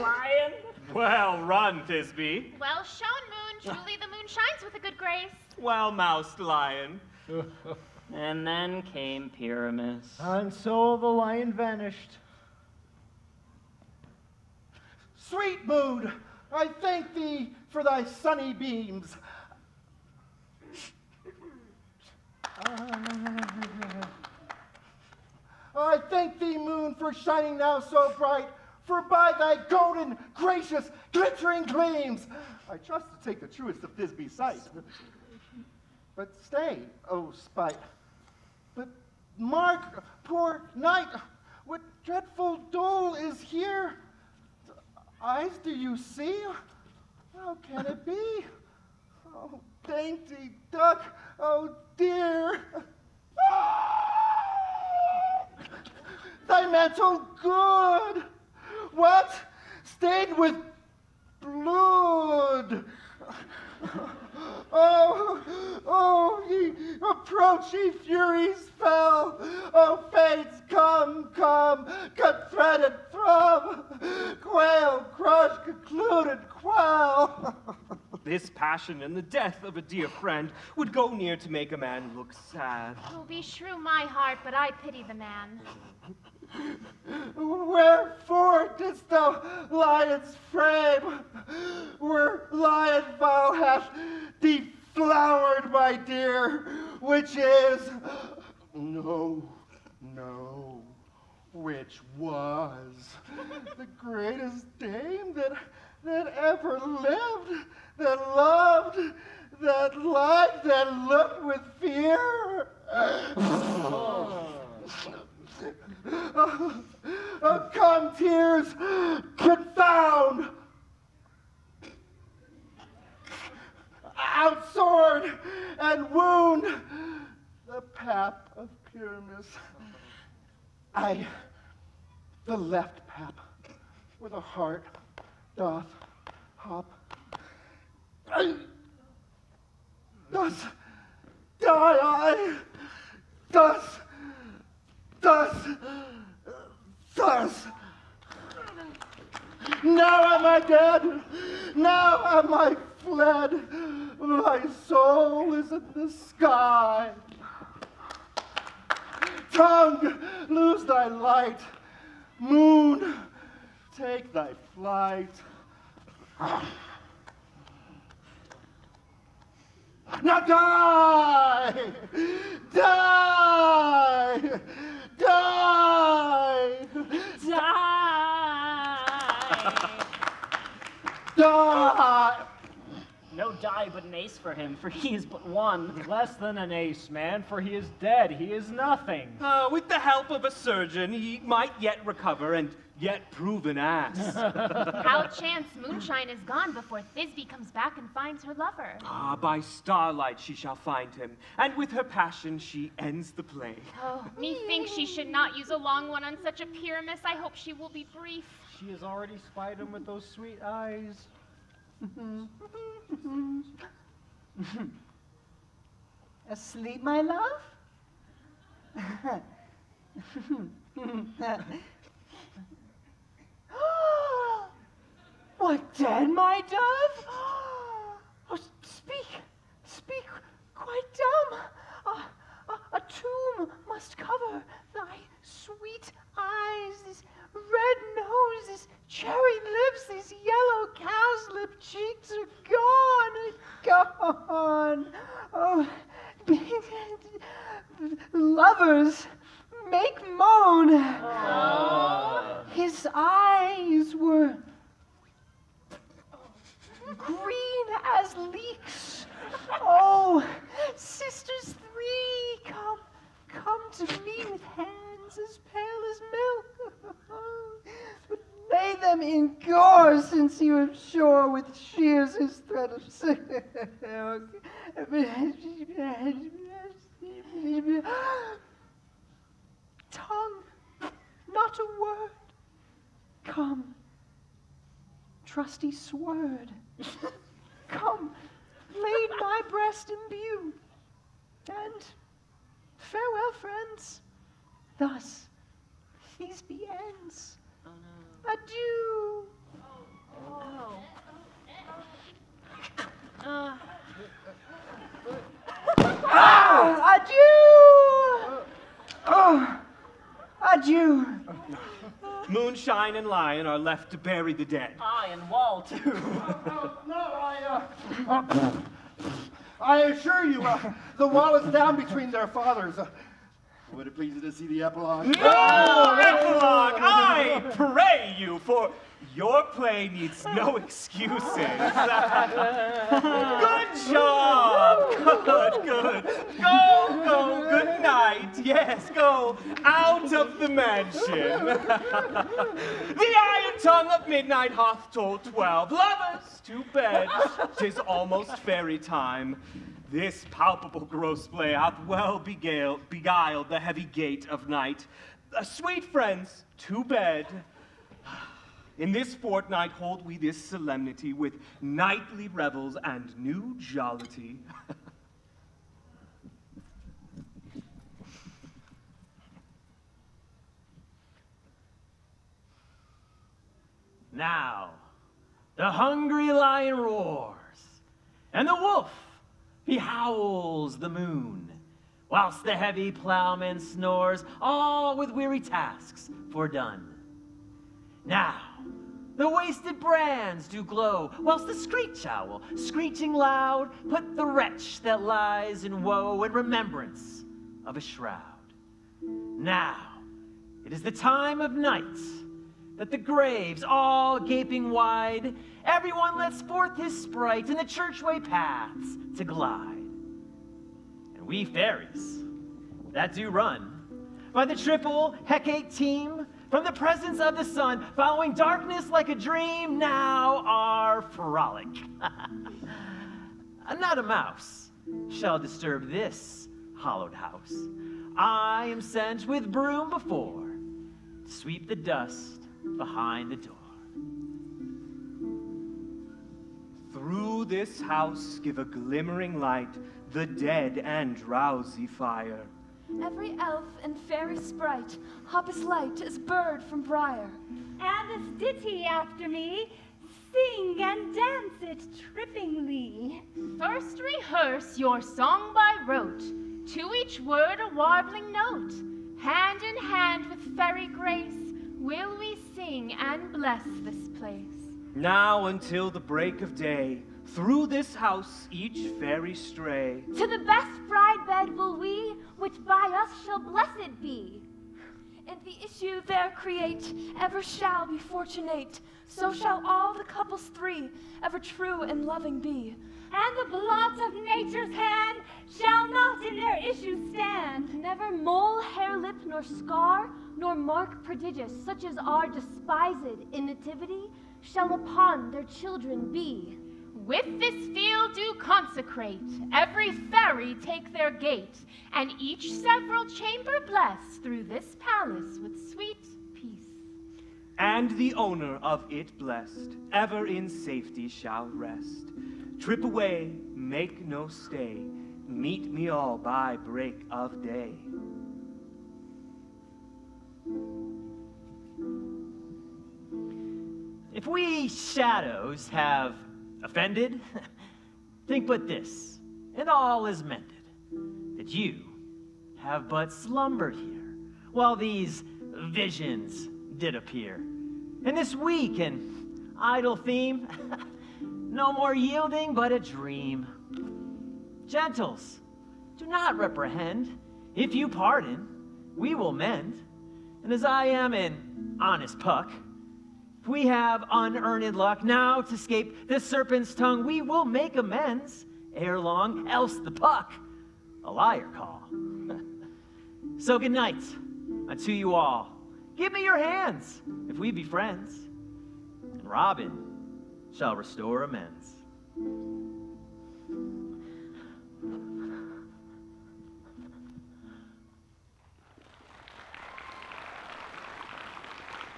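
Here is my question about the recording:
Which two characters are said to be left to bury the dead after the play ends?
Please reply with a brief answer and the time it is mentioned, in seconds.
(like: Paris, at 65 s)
Moonshine and Lion, at 312 s.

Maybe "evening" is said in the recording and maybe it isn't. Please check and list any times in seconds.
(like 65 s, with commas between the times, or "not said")
not said.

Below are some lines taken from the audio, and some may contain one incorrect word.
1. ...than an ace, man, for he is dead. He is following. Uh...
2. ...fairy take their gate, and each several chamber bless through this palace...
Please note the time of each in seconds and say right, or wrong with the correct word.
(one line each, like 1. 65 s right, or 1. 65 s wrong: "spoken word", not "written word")
1. 186 s wrong: "nothing", not "following"
2. 500 s right.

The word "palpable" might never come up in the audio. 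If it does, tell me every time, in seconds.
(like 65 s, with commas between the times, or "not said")
350 s.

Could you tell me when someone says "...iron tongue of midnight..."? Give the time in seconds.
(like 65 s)
343 s.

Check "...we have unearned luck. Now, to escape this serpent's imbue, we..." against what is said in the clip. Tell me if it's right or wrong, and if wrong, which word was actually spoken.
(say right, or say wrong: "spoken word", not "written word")
wrong: "tongue", not "imbue".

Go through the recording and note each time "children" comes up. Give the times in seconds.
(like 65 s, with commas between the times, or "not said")
495 s.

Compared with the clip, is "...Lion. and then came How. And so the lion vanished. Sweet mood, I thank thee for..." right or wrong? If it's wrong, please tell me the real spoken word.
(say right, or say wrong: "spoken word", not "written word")
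wrong: "Pyramus", not "How".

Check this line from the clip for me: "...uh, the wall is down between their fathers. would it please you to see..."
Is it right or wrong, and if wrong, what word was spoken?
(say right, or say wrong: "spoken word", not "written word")
right.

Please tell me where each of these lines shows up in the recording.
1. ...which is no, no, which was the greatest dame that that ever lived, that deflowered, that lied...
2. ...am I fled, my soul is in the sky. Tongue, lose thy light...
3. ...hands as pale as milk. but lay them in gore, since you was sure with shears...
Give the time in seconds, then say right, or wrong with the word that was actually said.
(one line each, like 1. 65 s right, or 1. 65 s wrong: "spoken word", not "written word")
1. 97 s wrong: "loved", not "deflowered"
2. 152 s right
3. 264 s right.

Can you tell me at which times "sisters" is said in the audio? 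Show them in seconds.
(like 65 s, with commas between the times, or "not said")
260 s.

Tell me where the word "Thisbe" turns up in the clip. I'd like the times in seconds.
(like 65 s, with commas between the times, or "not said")
1 s, 33 s, 197 s.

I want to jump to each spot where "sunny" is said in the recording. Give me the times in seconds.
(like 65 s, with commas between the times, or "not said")
18 s.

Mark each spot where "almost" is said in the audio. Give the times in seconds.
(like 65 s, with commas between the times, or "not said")
348 s.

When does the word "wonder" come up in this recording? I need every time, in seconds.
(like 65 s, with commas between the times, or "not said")
not said.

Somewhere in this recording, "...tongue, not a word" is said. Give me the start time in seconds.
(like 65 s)
280 s.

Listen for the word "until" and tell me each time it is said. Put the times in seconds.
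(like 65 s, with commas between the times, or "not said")
465 s.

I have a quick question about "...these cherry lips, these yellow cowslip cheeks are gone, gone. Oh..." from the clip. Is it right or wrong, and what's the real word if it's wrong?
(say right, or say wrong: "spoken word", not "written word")
right.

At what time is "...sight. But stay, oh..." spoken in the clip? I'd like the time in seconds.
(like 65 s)
34 s.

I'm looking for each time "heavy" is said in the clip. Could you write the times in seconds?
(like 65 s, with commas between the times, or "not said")
353 s, 382 s.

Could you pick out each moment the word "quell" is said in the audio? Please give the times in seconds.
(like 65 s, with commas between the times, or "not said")
76 s.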